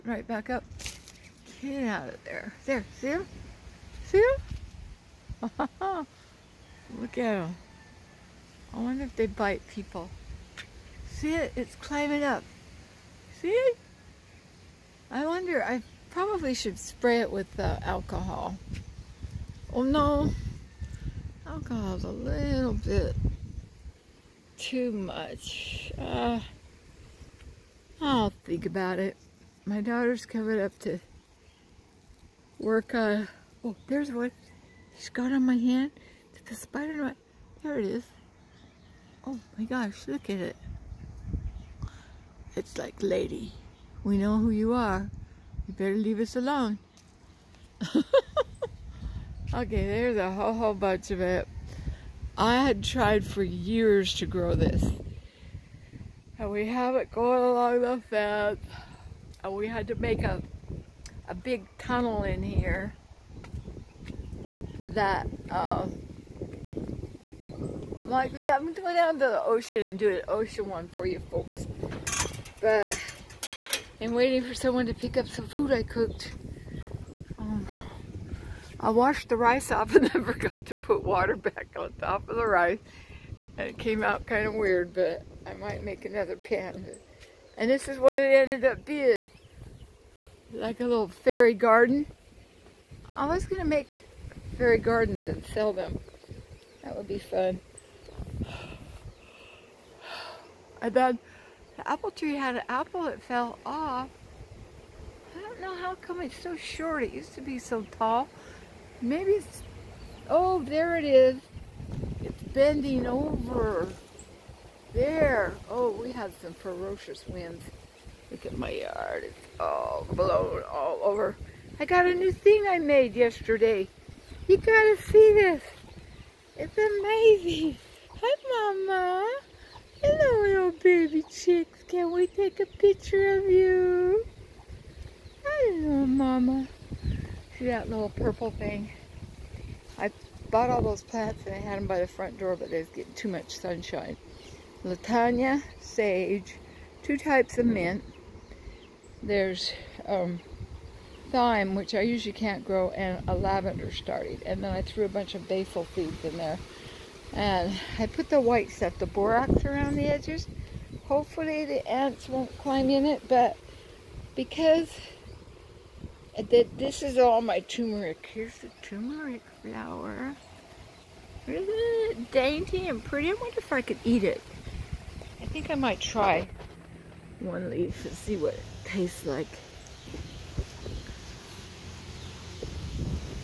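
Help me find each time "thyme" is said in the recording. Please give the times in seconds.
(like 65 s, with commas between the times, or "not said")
151 s.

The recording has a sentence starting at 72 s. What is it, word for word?
But I'm waiting for someone to pick up some food I cooked.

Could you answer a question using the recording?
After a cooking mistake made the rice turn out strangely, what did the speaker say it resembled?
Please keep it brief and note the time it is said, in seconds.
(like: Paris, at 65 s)
a little fairy garden, at 90 s.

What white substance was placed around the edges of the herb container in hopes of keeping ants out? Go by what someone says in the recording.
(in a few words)
borax.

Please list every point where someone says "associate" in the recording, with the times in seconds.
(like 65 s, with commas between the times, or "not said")
not said.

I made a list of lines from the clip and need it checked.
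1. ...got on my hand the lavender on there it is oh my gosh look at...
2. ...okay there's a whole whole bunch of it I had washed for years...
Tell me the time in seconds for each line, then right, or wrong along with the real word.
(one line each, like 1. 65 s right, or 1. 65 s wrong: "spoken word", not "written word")
1. 35 s wrong: "spider", not "lavender"
2. 49 s wrong: "tried", not "washed".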